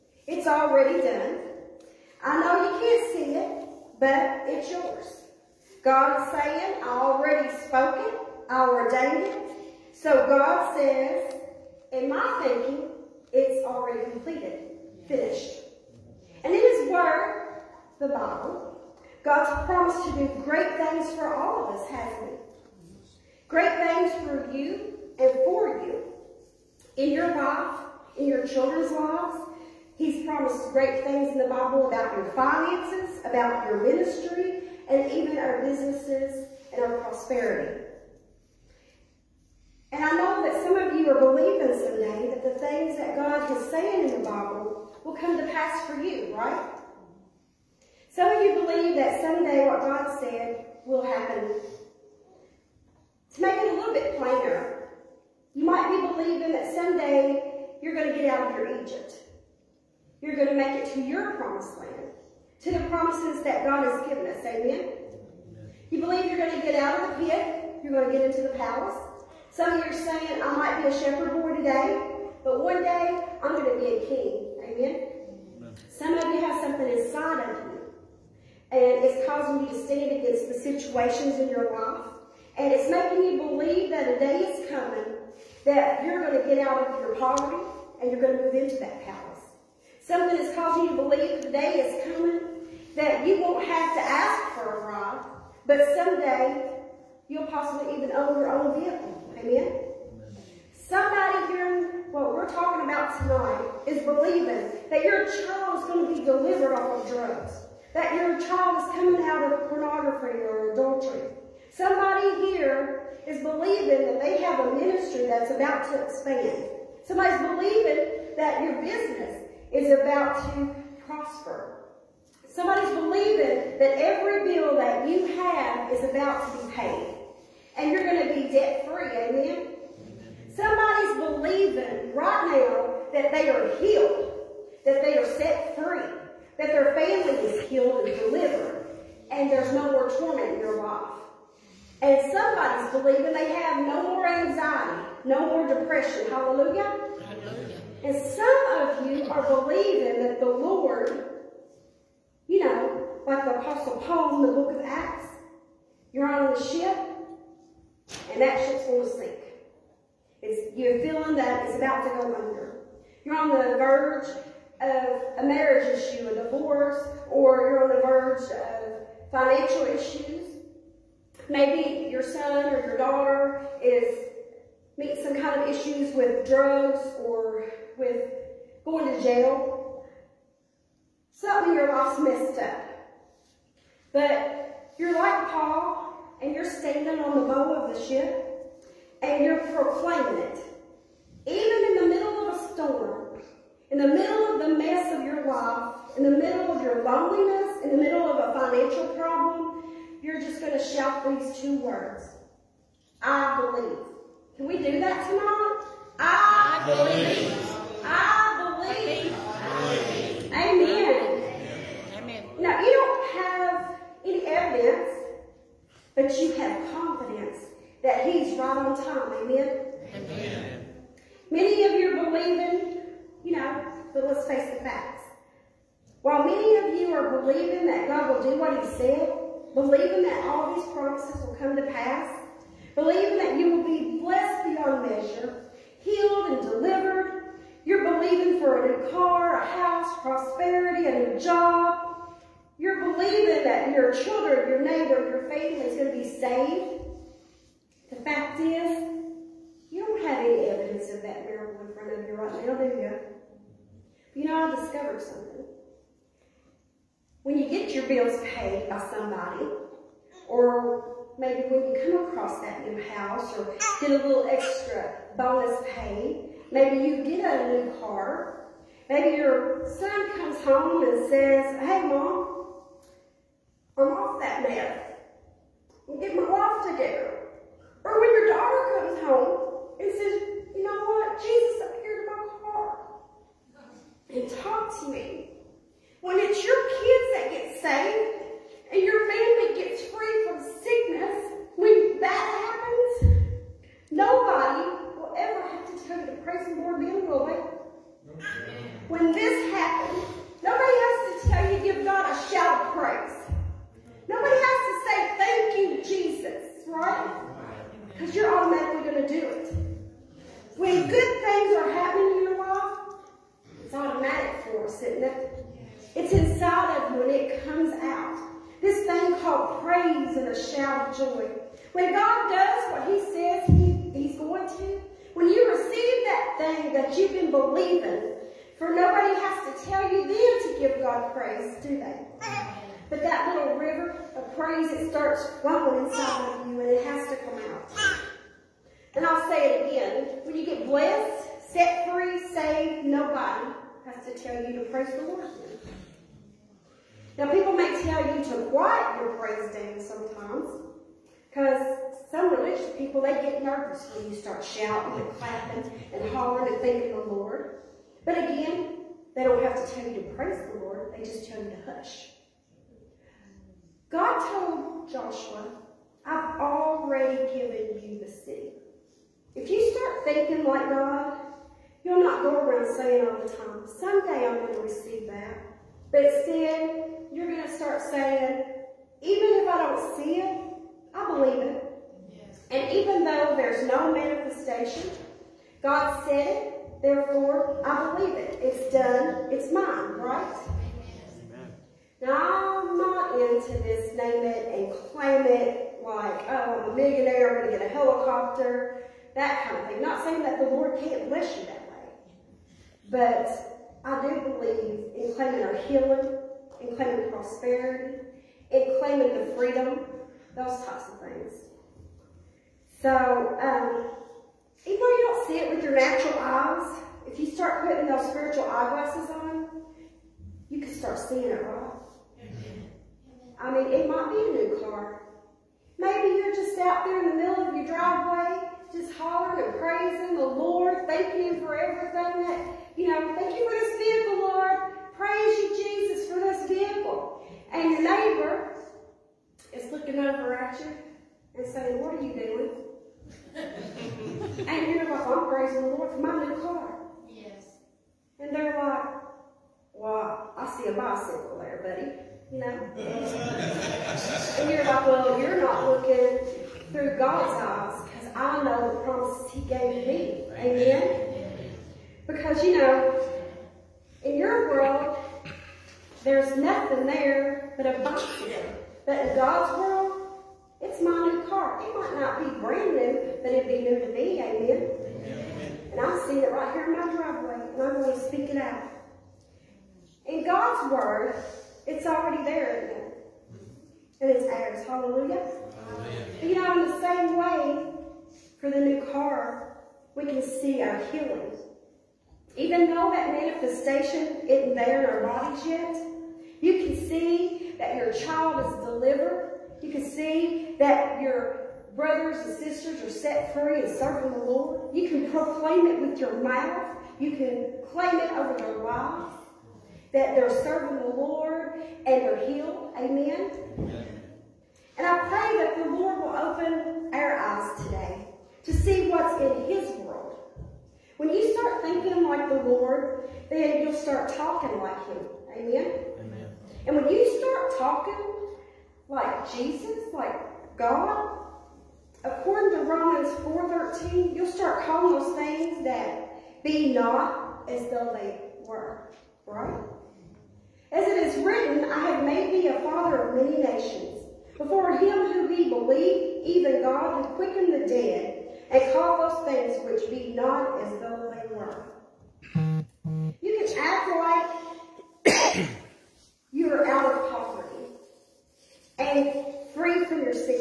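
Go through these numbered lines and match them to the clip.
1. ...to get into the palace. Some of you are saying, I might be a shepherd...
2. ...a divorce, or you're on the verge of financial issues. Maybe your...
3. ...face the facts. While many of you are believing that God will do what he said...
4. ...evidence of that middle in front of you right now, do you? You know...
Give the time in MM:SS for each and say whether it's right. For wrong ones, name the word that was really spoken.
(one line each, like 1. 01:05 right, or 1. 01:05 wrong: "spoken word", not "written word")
1. 01:08 right
2. 02:46 right
3. 03:44 right
4. 04:10 wrong: "miracle", not "middle".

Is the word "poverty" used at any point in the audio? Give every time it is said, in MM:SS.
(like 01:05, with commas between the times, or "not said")
01:27, 09:17.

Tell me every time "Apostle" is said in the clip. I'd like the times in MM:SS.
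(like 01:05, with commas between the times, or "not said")
02:33.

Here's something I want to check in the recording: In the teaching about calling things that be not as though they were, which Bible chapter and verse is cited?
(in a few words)
Romans 4:13.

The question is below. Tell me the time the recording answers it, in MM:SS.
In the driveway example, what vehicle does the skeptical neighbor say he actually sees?
07:30.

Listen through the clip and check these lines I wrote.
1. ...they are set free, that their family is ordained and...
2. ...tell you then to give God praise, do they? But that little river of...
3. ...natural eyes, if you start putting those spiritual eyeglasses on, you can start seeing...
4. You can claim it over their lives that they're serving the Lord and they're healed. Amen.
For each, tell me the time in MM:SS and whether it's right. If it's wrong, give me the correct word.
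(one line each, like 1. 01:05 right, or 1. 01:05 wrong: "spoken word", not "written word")
1. 02:15 wrong: "healed", not "ordained"
2. 05:29 right
3. 06:55 right
4. 08:27 right.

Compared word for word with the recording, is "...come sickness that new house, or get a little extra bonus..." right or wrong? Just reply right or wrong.
wrong.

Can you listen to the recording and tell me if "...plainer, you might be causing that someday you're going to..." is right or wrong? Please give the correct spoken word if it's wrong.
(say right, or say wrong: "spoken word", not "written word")
wrong: "believing", not "causing".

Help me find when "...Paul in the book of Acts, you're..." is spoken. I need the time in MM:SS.
02:33.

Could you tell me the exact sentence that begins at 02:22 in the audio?
And somebody's believing they have no more anxiety, no more depression.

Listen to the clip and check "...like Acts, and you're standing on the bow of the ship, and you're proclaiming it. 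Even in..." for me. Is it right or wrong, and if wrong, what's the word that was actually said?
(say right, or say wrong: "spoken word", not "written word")
wrong: "Paul", not "Acts".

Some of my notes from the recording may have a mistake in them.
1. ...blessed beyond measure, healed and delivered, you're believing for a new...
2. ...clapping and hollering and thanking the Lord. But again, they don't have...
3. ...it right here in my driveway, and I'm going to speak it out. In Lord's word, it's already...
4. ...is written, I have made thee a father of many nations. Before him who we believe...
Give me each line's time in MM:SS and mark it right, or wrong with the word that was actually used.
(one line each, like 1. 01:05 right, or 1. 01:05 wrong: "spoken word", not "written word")
1. 03:54 right
2. 05:55 right
3. 07:56 wrong: "God", not "Lord"
4. 09:01 right.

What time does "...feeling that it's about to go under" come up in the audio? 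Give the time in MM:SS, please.
02:41.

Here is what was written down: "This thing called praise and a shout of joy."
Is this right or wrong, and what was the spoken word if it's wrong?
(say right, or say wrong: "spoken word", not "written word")
right.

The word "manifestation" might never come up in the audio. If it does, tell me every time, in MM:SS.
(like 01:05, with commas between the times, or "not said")
06:24, 08:13.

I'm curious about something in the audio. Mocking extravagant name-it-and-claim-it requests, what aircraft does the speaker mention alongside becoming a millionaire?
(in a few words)
A helicopter.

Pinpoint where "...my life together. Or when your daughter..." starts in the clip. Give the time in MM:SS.
04:36.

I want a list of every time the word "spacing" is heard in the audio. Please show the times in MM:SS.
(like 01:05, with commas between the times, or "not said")
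not said.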